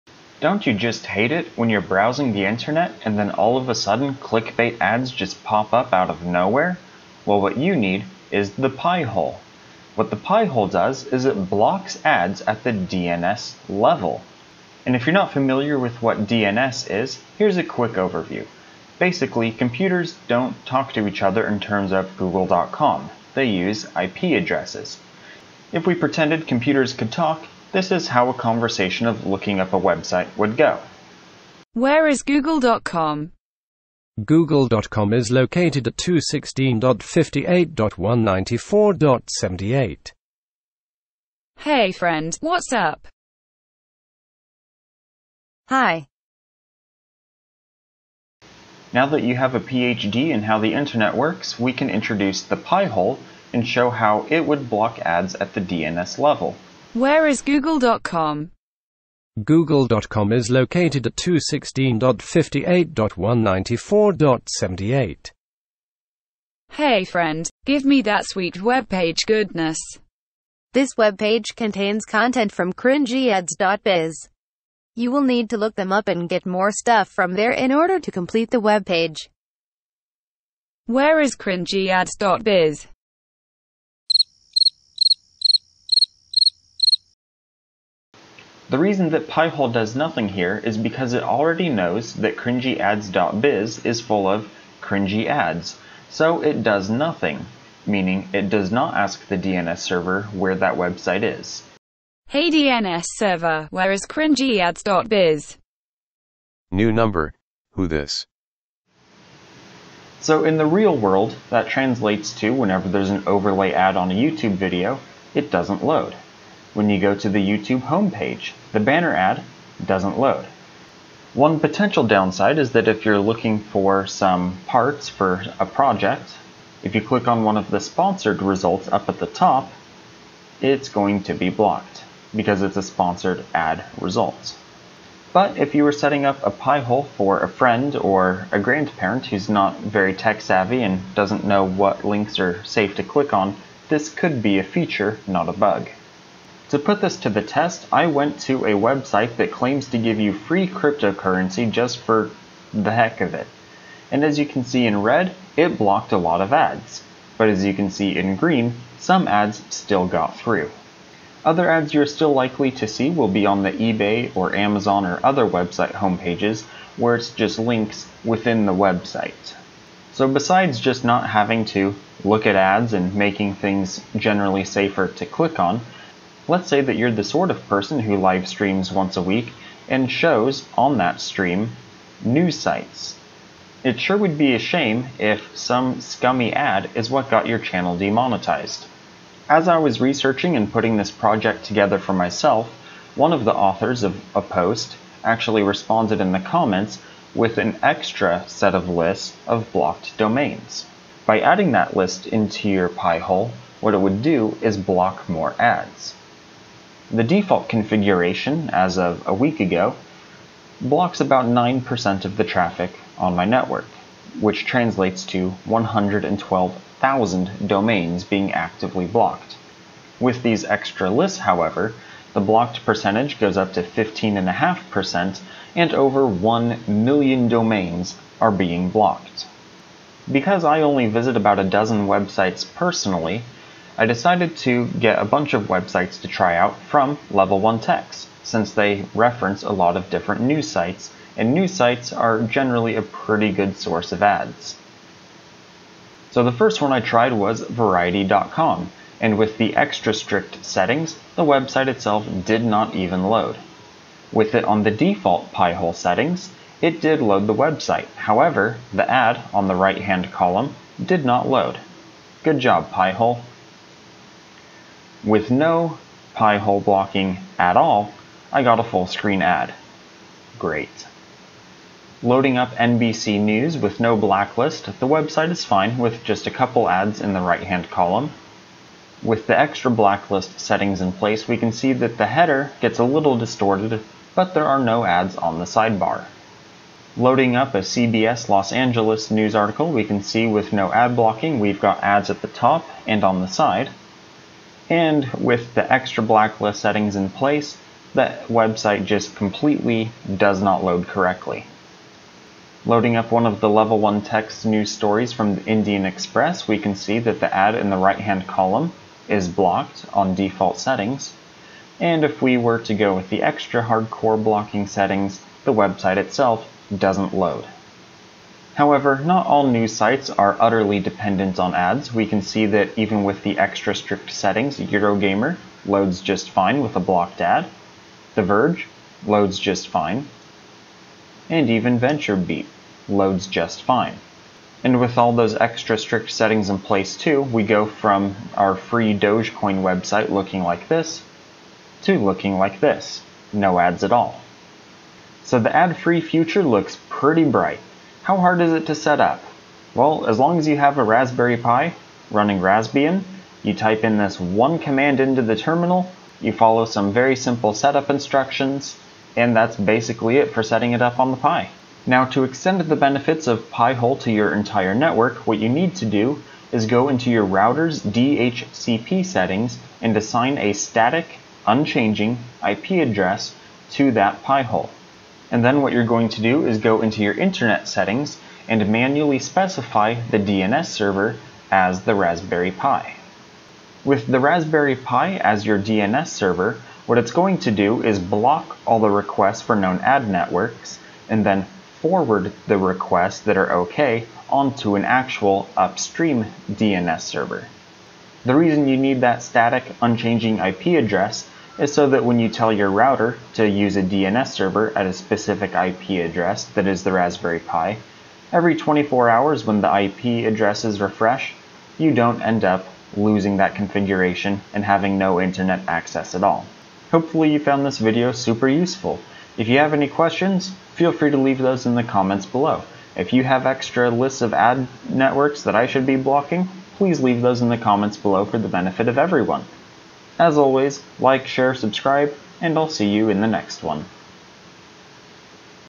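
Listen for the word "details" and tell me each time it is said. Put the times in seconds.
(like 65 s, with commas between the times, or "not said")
not said.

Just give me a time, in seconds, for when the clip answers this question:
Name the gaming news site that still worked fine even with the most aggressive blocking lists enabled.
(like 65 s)
324 s.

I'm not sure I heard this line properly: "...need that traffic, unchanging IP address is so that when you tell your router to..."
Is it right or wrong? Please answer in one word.
wrong.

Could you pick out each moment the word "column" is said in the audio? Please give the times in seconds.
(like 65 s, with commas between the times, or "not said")
260 s, 277 s, 308 s.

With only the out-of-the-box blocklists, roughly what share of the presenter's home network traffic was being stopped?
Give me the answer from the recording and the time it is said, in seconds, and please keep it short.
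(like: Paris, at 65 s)
9%, at 211 s.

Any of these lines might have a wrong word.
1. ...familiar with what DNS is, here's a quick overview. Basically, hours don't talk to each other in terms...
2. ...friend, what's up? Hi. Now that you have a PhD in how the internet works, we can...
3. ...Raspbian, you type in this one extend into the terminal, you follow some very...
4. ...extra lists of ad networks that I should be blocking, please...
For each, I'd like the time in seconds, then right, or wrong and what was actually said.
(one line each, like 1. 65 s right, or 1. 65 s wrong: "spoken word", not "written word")
1. 15 s wrong: "computers", not "hours"
2. 41 s right
3. 352 s wrong: "command", not "extend"
4. 423 s right.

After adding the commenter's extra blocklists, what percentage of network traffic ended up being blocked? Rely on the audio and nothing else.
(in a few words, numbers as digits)
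15.5%.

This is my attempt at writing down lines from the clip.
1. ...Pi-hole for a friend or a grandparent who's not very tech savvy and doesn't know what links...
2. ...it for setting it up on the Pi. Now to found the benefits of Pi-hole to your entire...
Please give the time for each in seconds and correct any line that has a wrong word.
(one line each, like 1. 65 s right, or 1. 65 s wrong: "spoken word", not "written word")
1. 136 s right
2. 360 s wrong: "extend", not "found".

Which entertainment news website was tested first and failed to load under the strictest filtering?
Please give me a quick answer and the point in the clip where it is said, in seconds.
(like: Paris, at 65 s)
Variety.com, at 247 s.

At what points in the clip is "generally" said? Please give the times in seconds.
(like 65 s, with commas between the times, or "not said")
174 s, 242 s.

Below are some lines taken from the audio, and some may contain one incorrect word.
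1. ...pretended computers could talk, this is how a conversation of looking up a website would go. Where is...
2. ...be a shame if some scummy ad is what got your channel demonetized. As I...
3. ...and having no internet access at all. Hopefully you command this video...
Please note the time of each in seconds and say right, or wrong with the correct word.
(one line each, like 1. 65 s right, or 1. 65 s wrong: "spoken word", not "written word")
1. 25 s right
2. 184 s right
3. 414 s wrong: "found", not "command".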